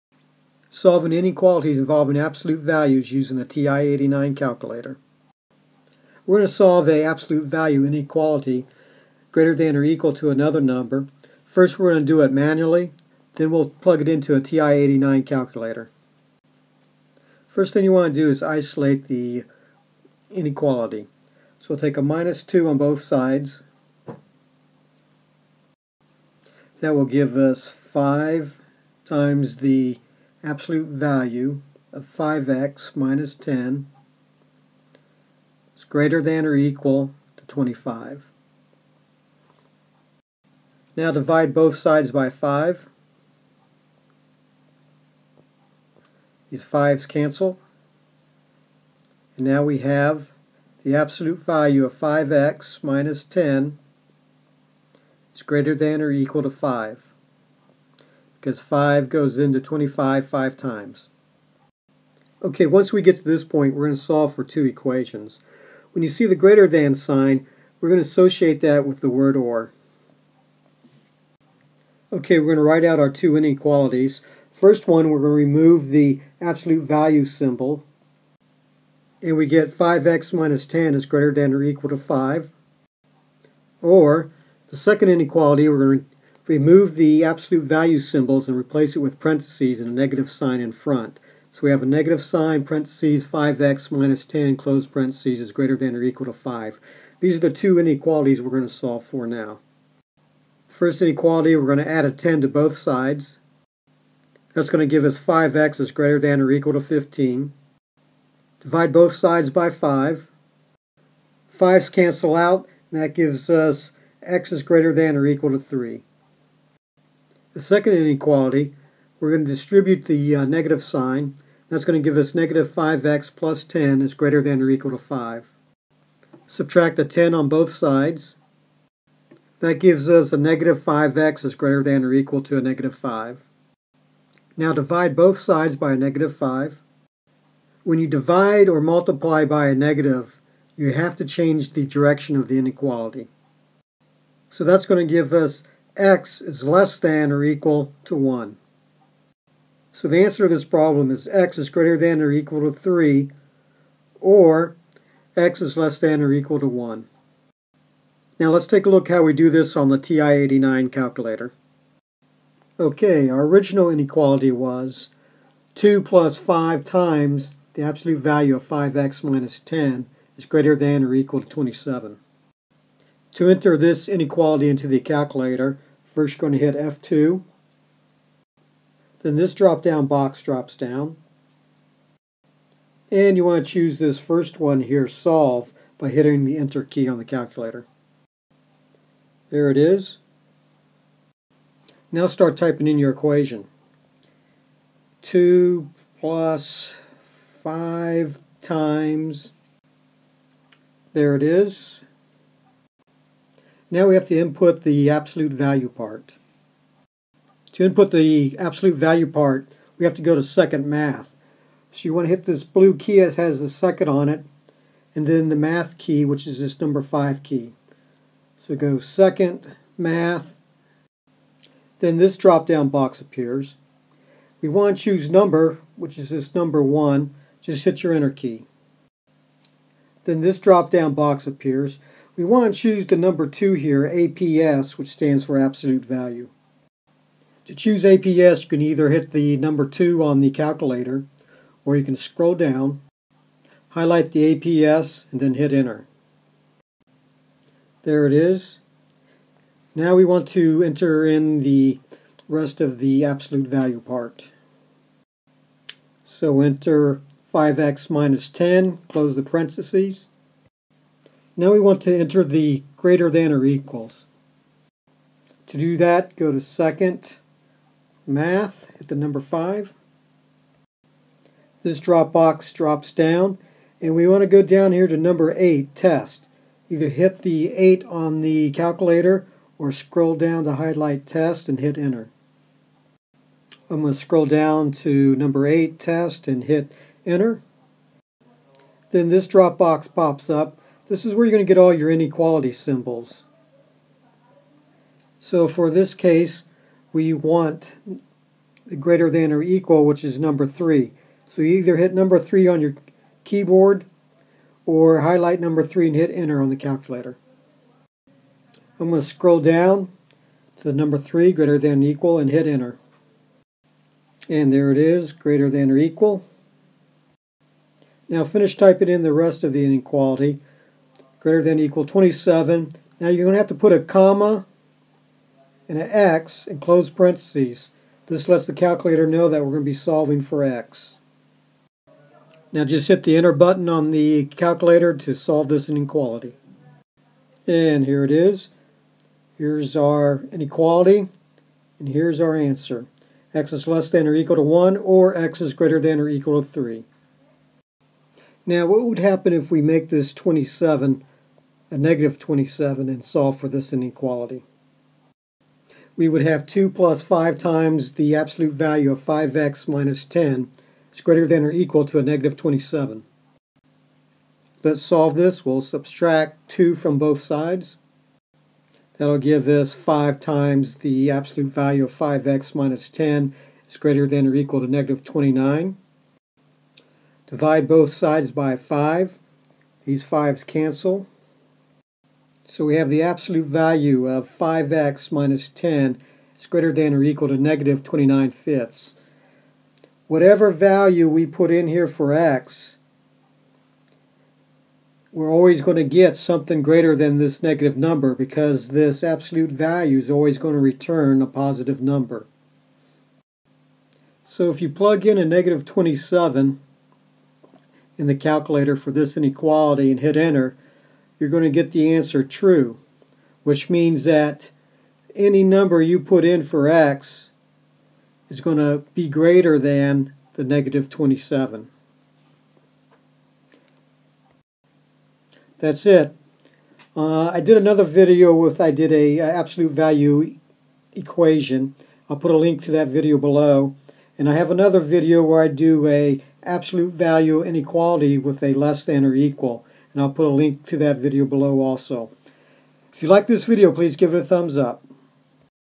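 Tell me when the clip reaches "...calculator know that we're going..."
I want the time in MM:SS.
05:28.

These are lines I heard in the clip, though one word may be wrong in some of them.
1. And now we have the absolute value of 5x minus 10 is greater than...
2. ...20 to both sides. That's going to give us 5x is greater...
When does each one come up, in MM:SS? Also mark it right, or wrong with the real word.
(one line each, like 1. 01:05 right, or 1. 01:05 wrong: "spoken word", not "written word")
1. 00:49 right
2. 01:42 wrong: "10", not "20".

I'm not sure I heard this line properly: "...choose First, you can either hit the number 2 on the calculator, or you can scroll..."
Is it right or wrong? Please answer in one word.
wrong.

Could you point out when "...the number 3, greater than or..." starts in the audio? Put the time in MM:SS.
05:10.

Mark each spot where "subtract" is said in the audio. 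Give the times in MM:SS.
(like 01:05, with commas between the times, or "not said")
02:06, 06:05.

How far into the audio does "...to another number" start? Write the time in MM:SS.
00:10.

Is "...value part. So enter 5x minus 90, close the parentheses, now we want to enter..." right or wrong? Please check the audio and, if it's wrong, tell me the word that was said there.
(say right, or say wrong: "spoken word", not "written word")
wrong: "10", not "90".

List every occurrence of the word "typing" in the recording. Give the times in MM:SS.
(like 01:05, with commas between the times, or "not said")
03:12, 05:18.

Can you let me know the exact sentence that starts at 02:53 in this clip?
To enter this inequality into the calculator, First you're going to hit F2.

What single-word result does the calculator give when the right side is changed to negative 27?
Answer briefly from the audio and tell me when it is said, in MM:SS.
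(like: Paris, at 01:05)
true, at 06:52.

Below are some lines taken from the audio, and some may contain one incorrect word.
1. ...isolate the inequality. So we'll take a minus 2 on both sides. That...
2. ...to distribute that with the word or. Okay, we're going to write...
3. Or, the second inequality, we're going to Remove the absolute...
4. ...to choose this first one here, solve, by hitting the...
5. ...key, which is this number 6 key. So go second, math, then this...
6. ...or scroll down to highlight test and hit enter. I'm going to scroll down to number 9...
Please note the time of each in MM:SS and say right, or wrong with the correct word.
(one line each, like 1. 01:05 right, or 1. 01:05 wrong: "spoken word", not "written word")
1. 00:18 right
2. 01:08 wrong: "associate", not "distribute"
3. 01:23 right
4. 03:03 right
5. 03:35 wrong: "5", not "6"
6. 04:39 wrong: "8", not "9".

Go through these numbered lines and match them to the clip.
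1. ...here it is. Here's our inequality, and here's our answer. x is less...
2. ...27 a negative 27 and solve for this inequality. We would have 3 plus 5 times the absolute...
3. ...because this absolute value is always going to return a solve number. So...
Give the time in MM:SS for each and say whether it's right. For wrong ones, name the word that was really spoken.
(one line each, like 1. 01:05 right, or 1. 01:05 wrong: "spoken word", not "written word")
1. 05:38 right
2. 05:50 wrong: "2", not "3"
3. 06:38 wrong: "positive", not "solve".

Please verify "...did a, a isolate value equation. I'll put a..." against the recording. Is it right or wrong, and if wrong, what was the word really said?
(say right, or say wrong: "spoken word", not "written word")
wrong: "absolute", not "isolate".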